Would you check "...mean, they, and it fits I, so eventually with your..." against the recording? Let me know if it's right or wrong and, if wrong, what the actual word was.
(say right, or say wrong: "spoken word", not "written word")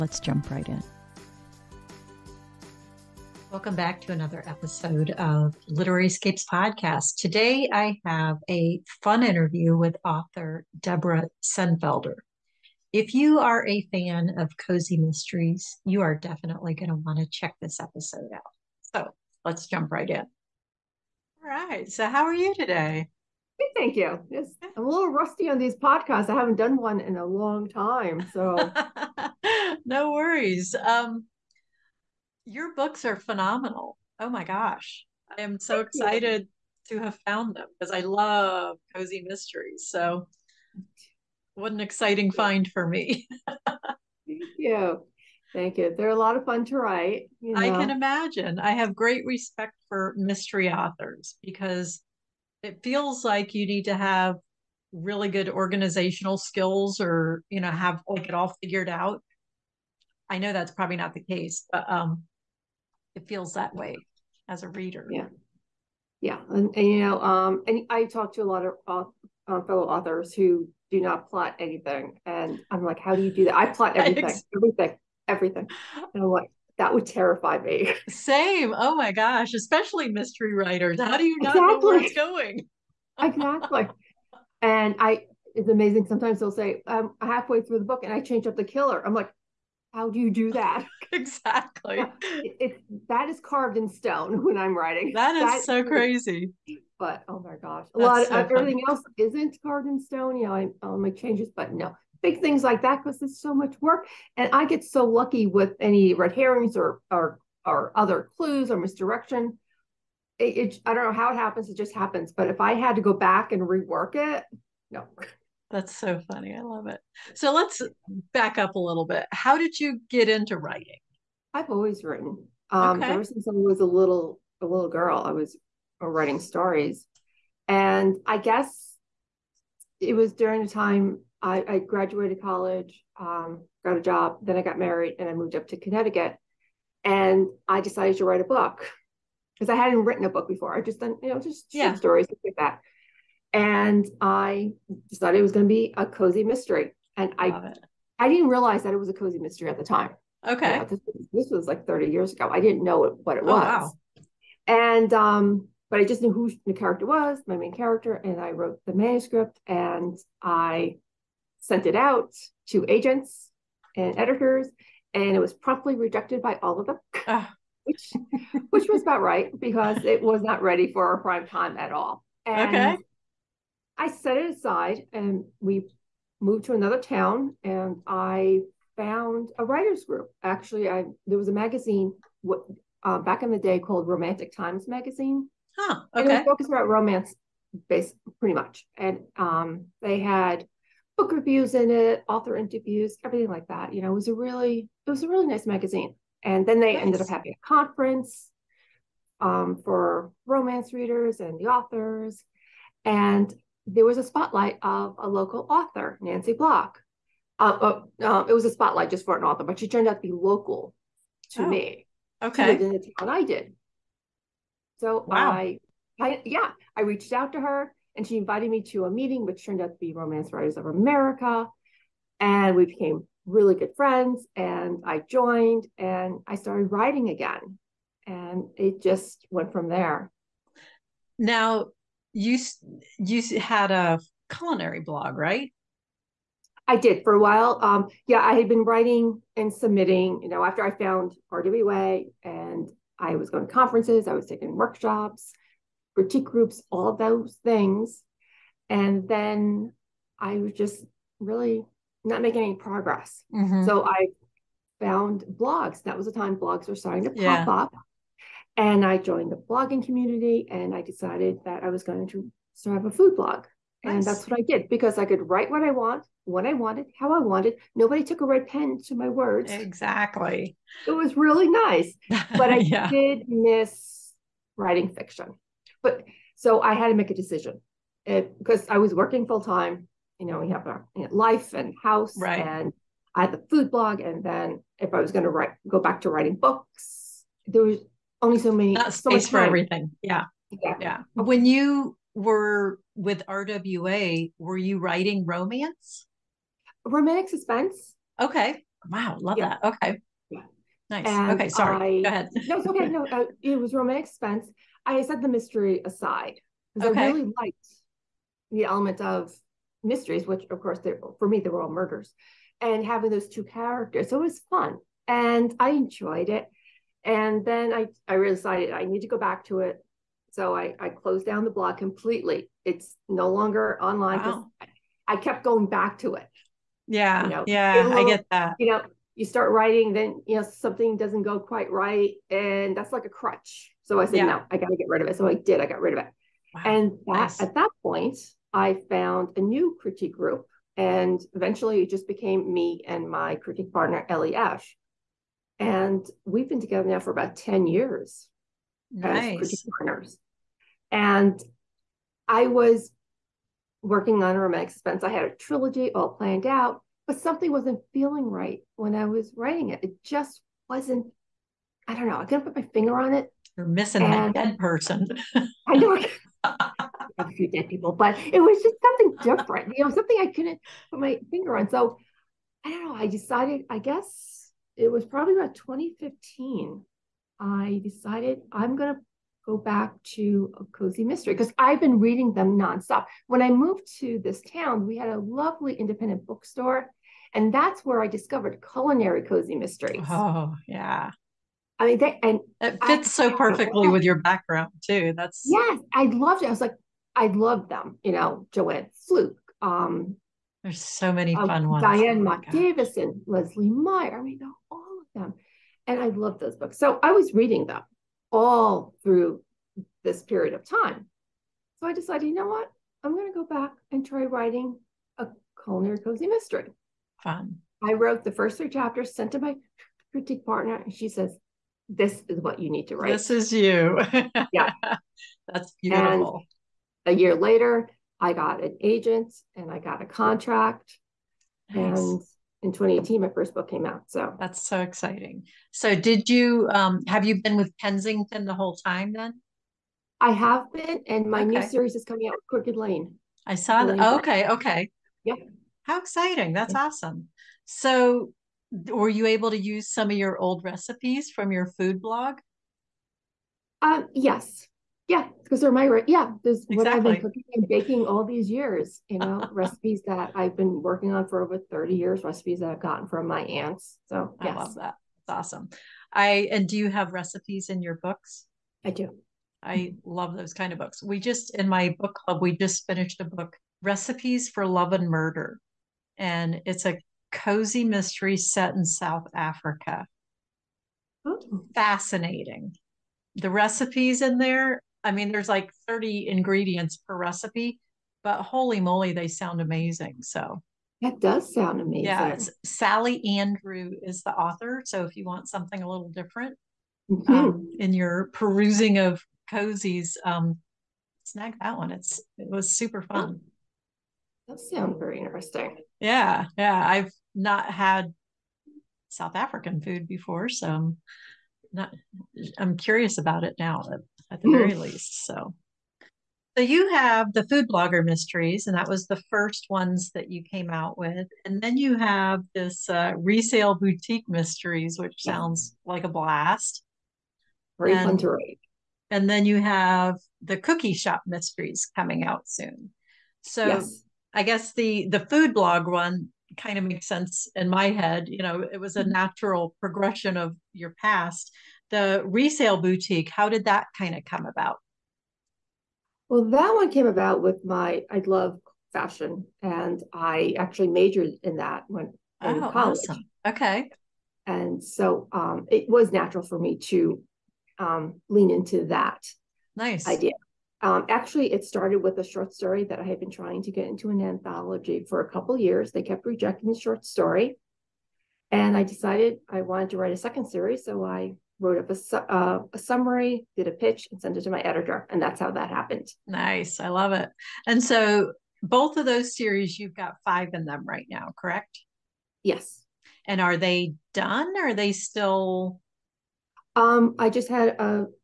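wrong: "perfectly", not "eventually".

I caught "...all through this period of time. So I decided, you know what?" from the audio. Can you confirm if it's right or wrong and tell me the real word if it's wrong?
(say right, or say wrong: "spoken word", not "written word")
right.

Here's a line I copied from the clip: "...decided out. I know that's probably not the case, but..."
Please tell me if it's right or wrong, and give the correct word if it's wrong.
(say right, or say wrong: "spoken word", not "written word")
wrong: "figured", not "decided".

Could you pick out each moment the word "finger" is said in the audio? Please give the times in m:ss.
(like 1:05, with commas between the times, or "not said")
6:02, 6:11.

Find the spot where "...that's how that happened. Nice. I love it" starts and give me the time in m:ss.
9:35.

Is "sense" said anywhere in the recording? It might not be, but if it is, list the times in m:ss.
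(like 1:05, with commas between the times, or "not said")
8:57.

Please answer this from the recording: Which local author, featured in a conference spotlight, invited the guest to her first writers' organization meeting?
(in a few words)
Nancy Block.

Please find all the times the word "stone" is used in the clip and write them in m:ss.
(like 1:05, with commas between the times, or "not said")
1:33, 1:40.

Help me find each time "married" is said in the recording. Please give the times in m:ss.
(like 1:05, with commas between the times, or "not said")
2:14.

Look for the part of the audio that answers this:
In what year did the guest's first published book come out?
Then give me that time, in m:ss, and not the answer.
7:12.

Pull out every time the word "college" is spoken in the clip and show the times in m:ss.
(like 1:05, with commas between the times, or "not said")
2:12, 9:12.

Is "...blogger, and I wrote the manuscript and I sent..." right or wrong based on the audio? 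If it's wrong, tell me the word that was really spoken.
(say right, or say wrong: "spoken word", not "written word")
wrong: "character", not "blogger".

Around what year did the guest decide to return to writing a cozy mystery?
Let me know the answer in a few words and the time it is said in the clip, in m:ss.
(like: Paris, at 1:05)
2015, at 6:15.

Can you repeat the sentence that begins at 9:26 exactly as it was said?
They kept rejecting the short story.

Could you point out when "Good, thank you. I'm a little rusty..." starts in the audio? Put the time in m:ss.
0:23.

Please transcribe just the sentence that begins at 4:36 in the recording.
But so I had to make a decision it, eh, because I was working full time.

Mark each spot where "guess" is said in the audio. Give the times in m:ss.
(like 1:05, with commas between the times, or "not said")
2:08, 6:13, 8:54.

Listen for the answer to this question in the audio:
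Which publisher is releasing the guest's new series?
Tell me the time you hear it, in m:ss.
7:22.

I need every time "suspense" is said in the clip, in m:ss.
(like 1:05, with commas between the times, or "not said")
4:57, 5:04, 5:54.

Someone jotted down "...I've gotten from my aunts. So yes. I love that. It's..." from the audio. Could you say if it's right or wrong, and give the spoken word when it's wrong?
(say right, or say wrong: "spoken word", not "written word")
right.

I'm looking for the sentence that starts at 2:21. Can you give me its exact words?
short stories like that and I decided it was going to be a cozy mystery.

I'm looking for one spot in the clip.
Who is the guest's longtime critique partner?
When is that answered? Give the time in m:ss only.
5:44.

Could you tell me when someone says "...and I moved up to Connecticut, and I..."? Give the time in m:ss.
2:15.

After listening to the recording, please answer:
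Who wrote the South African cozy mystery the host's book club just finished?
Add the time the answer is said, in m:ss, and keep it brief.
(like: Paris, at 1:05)
Sally Andrew, at 8:12.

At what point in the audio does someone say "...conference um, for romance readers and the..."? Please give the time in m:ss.
3:17.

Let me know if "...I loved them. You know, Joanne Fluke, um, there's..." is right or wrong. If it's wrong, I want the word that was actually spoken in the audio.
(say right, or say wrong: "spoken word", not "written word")
right.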